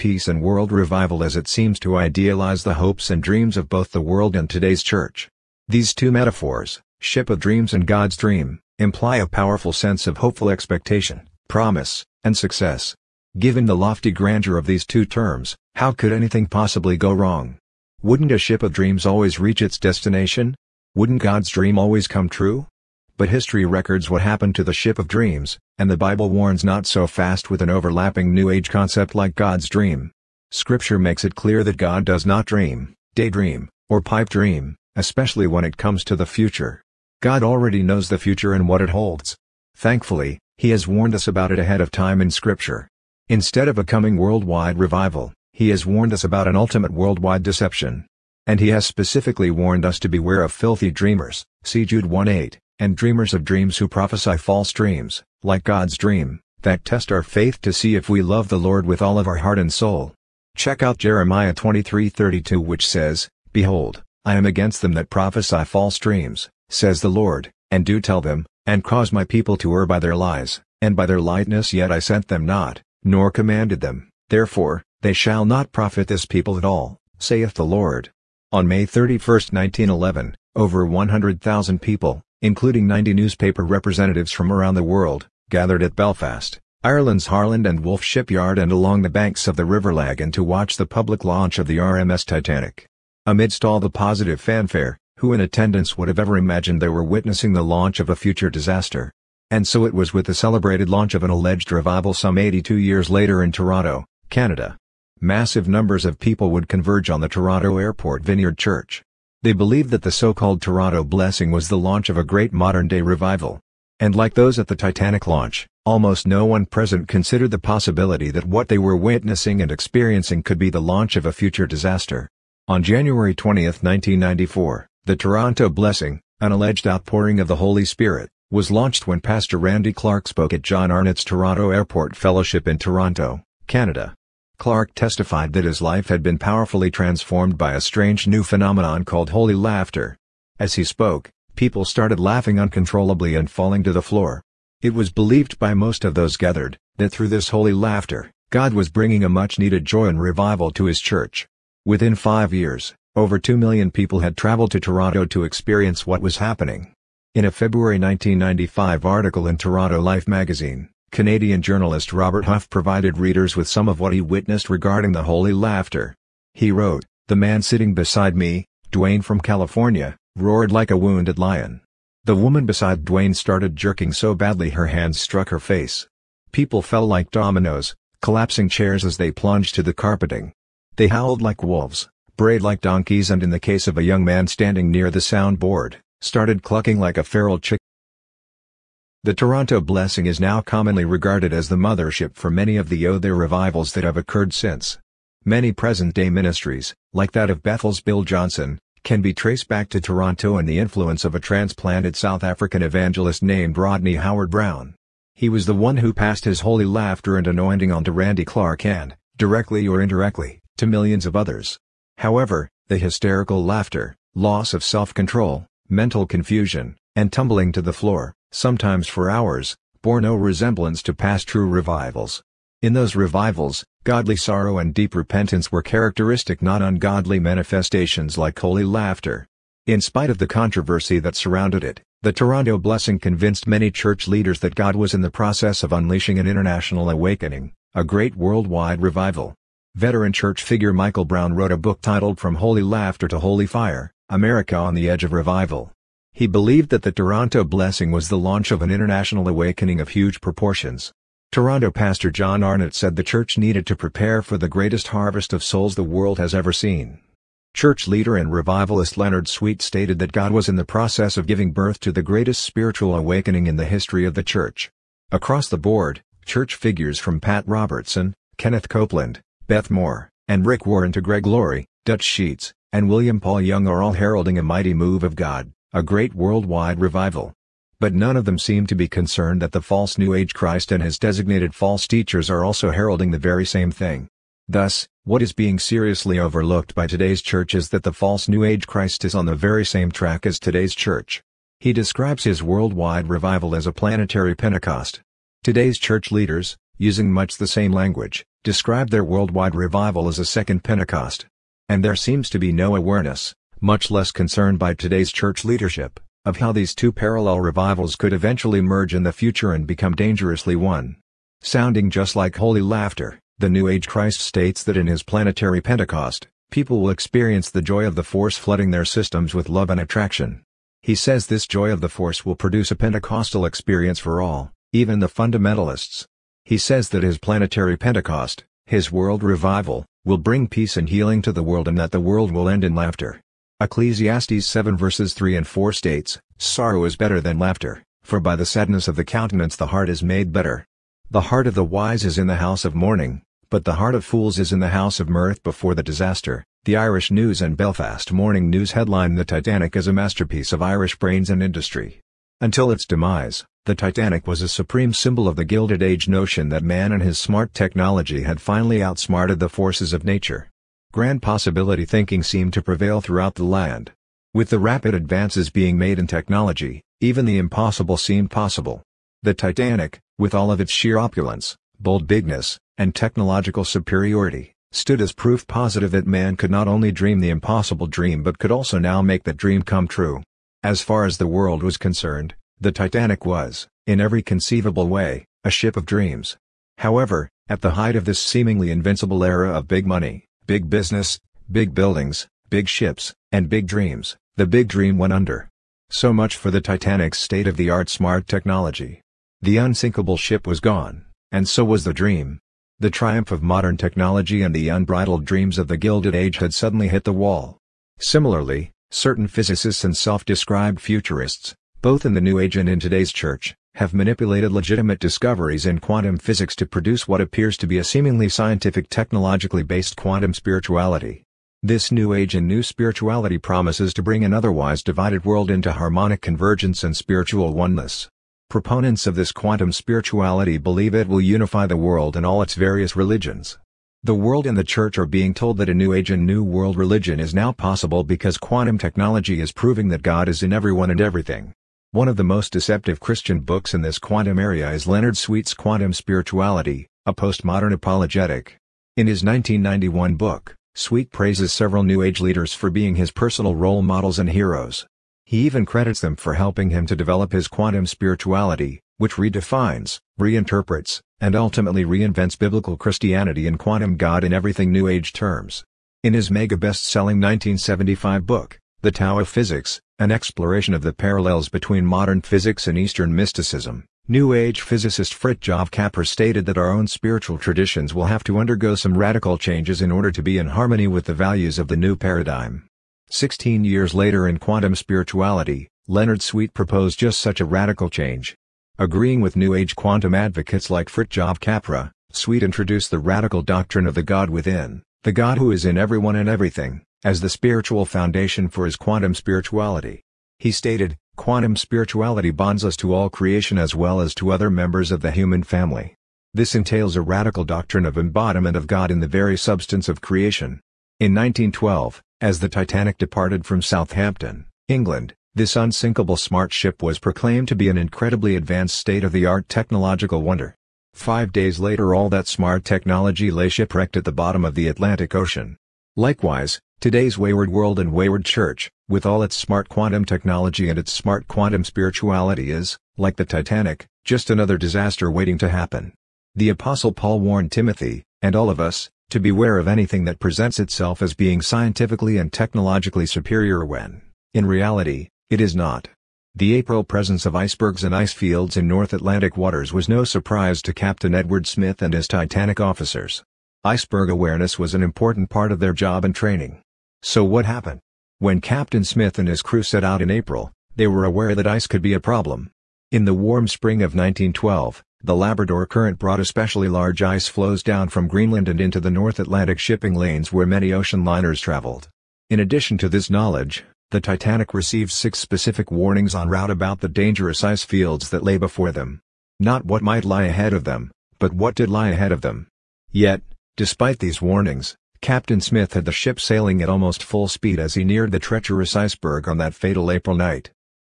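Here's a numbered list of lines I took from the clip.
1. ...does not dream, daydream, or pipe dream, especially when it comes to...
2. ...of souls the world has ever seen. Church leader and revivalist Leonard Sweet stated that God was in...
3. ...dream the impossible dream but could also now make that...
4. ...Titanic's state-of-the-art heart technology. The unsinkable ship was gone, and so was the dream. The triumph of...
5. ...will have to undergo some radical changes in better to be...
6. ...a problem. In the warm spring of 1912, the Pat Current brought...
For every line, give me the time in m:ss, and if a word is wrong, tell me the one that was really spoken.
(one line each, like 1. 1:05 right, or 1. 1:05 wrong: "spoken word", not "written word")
1. 0:32 right
2. 4:15 right
3. 6:17 right
4. 6:36 wrong: "smart", not "heart"
5. 7:58 wrong: "order", not "better"
6. 9:22 wrong: "Labrador", not "Pat".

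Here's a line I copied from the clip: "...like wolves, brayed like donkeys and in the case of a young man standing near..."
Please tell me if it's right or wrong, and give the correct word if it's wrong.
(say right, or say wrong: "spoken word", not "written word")
right.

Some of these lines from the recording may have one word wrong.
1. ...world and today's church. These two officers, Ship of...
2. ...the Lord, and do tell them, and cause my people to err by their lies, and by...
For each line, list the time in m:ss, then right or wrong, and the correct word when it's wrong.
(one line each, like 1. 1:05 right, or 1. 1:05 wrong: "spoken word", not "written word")
1. 0:03 wrong: "metaphors", not "officers"
2. 1:07 right.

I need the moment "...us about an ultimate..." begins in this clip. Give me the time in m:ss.
0:46.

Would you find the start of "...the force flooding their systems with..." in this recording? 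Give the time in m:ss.
5:18.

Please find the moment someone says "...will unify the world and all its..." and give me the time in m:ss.
7:11.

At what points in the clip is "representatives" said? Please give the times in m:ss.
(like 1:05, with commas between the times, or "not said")
1:23.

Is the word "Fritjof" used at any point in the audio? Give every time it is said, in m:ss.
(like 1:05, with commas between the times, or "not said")
7:55, 8:11.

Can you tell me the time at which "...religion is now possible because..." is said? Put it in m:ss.
7:16.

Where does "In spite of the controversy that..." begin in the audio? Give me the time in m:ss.
3:49.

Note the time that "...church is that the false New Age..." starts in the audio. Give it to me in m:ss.
4:47.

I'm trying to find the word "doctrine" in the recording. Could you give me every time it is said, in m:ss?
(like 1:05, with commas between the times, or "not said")
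8:13, 8:27.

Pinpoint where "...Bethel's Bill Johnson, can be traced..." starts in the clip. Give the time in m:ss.
3:17.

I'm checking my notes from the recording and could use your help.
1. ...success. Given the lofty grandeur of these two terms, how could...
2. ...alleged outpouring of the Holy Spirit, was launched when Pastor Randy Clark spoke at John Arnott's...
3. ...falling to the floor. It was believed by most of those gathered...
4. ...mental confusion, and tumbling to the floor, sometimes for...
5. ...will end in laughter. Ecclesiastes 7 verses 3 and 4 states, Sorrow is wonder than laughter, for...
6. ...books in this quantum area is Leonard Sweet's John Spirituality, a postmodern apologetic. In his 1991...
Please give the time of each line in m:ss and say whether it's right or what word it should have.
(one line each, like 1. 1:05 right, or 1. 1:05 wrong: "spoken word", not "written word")
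1. 0:12 right
2. 2:06 right
3. 2:23 right
4. 3:35 right
5. 5:32 wrong: "better", not "wonder"
6. 7:23 wrong: "Quantum", not "John".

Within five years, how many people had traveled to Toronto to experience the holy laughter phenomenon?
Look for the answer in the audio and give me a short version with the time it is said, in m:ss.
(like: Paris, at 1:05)
2 million, at 2:33.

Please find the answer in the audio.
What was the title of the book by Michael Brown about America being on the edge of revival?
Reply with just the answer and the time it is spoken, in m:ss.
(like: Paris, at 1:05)
From Holy Laughter to Holy Fire, at 4:02.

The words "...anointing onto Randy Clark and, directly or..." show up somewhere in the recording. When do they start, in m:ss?
3:27.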